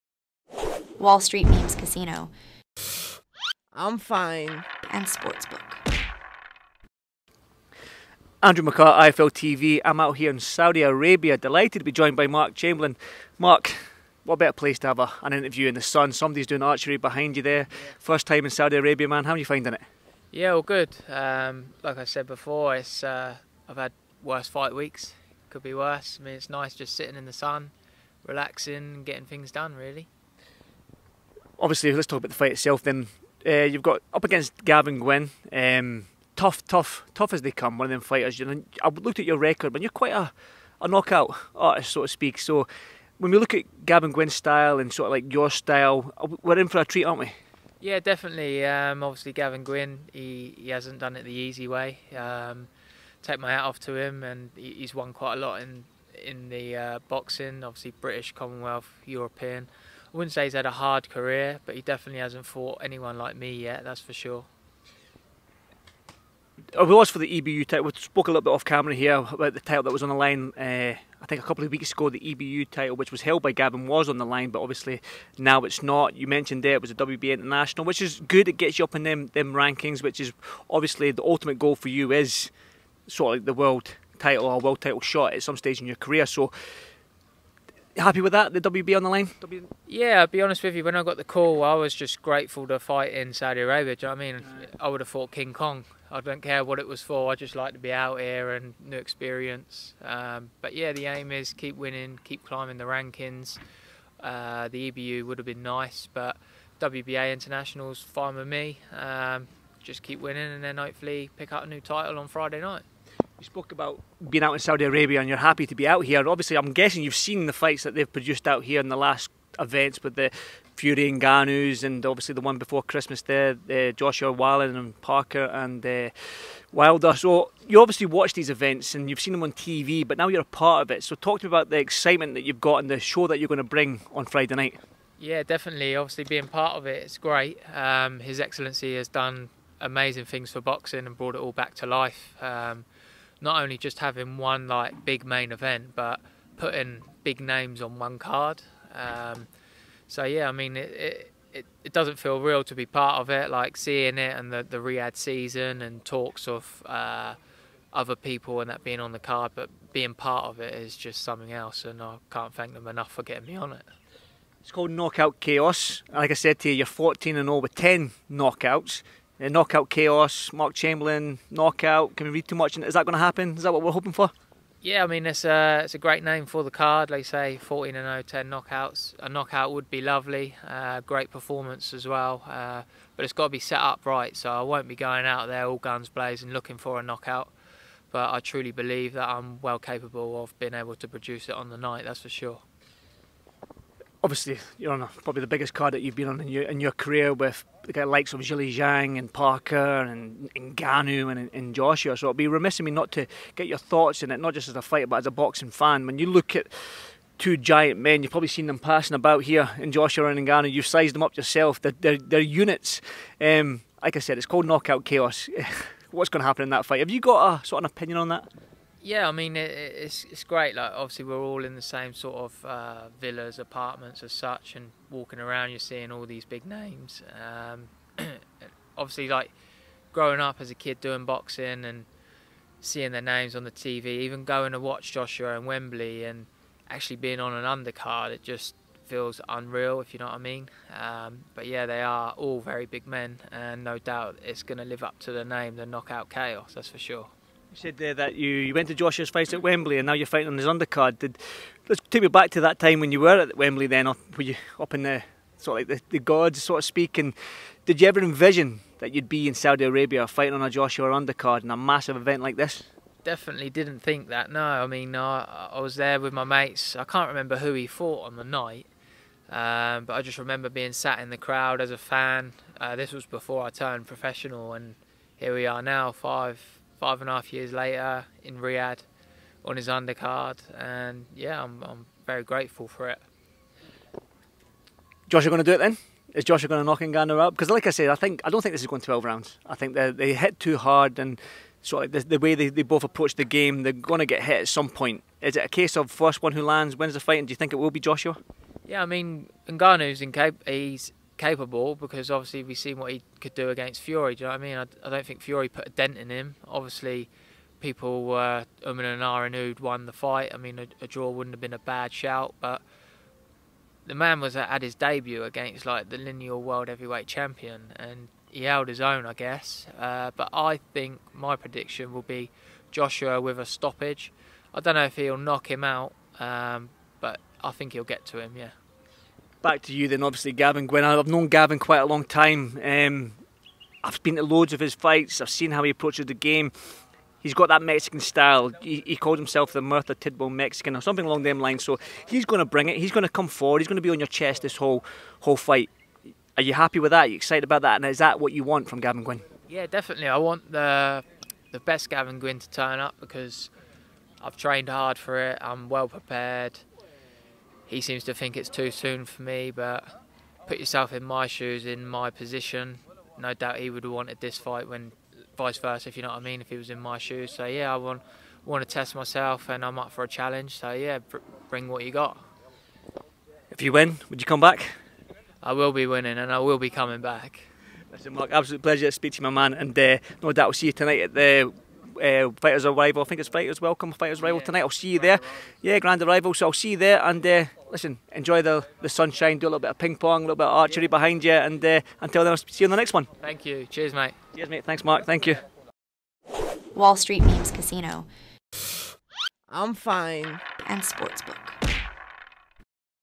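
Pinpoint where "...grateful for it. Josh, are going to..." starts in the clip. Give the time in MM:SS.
04:42.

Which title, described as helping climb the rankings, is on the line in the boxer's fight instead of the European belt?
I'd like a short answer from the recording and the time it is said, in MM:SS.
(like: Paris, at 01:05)
WBA International, at 01:16.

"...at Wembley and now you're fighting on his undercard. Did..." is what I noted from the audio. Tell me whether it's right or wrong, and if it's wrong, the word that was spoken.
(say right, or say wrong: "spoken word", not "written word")
right.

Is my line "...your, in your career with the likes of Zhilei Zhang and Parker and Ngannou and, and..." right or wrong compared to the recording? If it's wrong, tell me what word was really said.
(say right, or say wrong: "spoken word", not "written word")
right.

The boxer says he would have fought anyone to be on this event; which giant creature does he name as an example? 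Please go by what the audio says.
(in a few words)
King Kong.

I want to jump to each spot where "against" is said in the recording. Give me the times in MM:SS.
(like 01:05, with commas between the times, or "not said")
00:34, 05:03, 05:15.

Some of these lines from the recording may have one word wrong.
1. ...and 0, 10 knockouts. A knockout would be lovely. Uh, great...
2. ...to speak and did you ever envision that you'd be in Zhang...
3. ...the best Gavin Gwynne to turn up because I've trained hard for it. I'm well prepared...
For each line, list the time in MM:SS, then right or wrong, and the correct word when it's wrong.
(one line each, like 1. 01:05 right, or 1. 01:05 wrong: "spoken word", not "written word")
1. 02:57 right
2. 04:16 wrong: "Saudi", not "Zhang"
3. 05:51 right.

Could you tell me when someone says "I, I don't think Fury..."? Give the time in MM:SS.
05:04.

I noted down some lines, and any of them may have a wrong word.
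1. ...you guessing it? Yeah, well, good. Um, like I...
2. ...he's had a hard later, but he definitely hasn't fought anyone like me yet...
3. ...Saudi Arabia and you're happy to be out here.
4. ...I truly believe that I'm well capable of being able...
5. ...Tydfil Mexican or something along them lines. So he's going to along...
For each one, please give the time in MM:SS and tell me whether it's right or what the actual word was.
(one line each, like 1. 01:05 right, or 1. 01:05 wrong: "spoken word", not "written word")
1. 00:19 wrong: "finding", not "guessing"
2. 01:00 wrong: "career", not "later"
3. 01:54 right
4. 03:08 right
5. 05:40 wrong: "bring", not "along".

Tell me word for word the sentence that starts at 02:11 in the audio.
So talk to me about the excitement that you've got and the show that you're going to bring on Friday night.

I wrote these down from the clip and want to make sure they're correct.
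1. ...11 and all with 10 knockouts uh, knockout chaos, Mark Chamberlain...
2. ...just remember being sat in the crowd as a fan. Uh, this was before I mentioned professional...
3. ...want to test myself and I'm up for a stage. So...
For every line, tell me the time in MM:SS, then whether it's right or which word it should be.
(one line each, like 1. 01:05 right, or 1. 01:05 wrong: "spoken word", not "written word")
1. 02:46 wrong: "14", not "11"
2. 04:30 wrong: "turned", not "mentioned"
3. 06:08 wrong: "challenge", not "stage".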